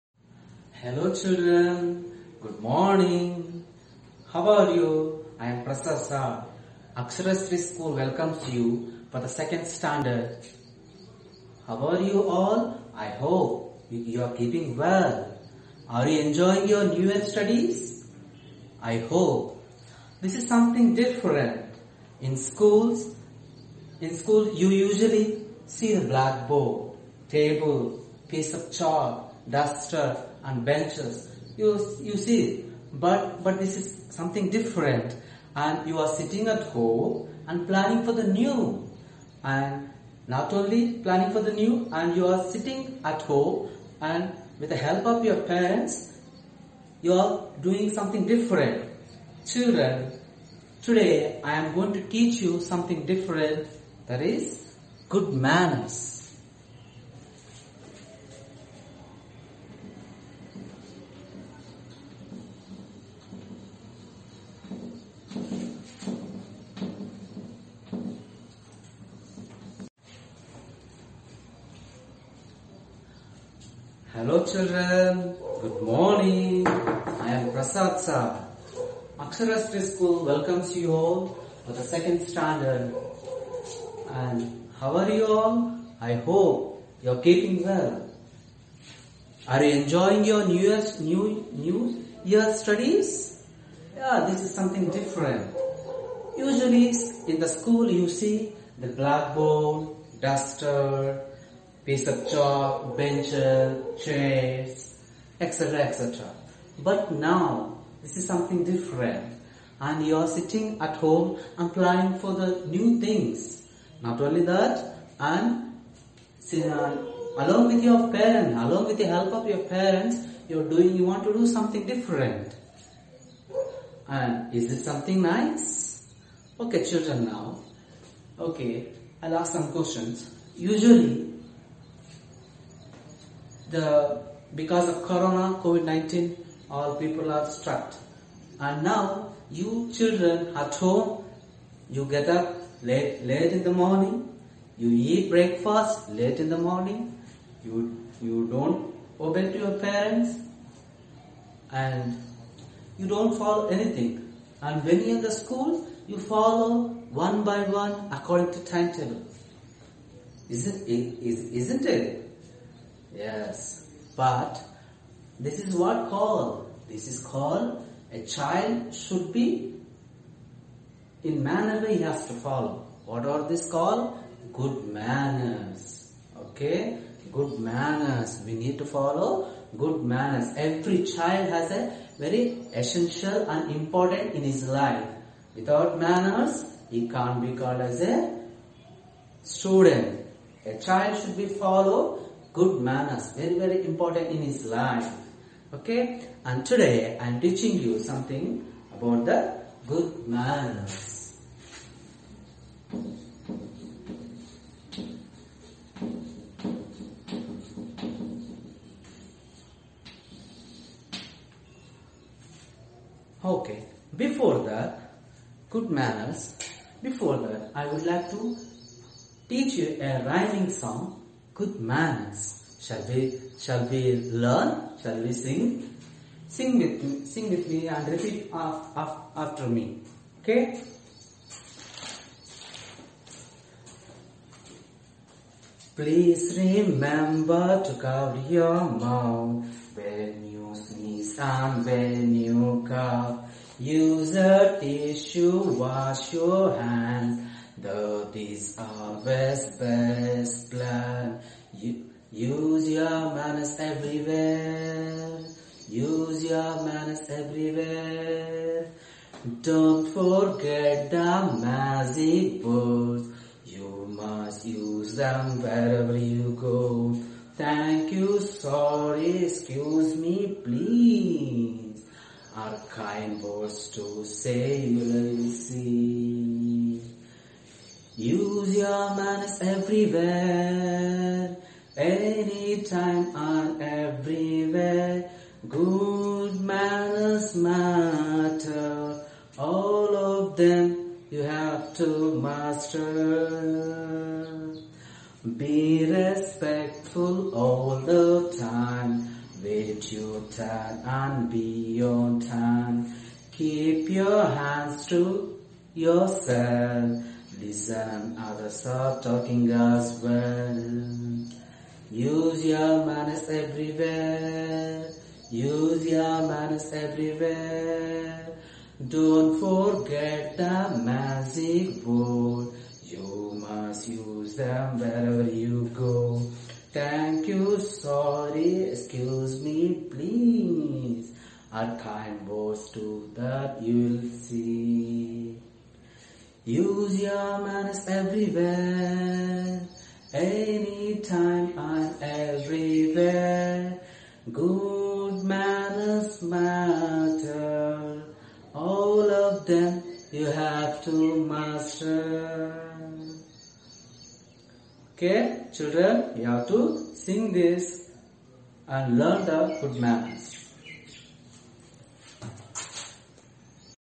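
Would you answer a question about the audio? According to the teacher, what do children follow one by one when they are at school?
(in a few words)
timetable.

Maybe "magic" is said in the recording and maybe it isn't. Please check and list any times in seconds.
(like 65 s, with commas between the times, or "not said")
261 s, 321 s.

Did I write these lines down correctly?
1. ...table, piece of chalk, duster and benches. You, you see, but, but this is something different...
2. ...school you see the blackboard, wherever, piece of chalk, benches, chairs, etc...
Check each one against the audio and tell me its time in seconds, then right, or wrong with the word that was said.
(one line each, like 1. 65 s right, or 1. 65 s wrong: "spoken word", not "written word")
1. 27 s right
2. 97 s wrong: "duster", not "wherever".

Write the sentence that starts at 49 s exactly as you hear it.
Children, today I am going to teach you something different that is good manners.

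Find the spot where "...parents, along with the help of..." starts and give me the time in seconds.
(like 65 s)
118 s.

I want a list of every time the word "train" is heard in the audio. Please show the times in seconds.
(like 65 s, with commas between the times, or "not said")
not said.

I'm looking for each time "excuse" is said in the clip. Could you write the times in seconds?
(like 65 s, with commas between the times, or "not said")
269 s, 328 s.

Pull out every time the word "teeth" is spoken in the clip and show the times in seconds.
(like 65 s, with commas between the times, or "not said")
not said.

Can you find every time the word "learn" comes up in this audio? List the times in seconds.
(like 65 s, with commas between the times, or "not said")
224 s, 359 s.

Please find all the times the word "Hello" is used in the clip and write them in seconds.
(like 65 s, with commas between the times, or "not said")
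0 s, 74 s.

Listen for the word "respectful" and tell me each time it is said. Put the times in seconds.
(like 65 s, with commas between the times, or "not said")
296 s.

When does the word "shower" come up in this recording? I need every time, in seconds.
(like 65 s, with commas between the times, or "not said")
not said.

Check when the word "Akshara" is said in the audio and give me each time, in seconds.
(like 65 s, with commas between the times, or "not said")
6 s, 79 s.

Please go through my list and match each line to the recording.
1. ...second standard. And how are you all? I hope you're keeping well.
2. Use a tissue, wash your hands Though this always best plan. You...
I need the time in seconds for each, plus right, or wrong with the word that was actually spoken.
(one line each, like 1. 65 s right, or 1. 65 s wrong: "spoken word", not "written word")
1. 81 s right
2. 243 s right.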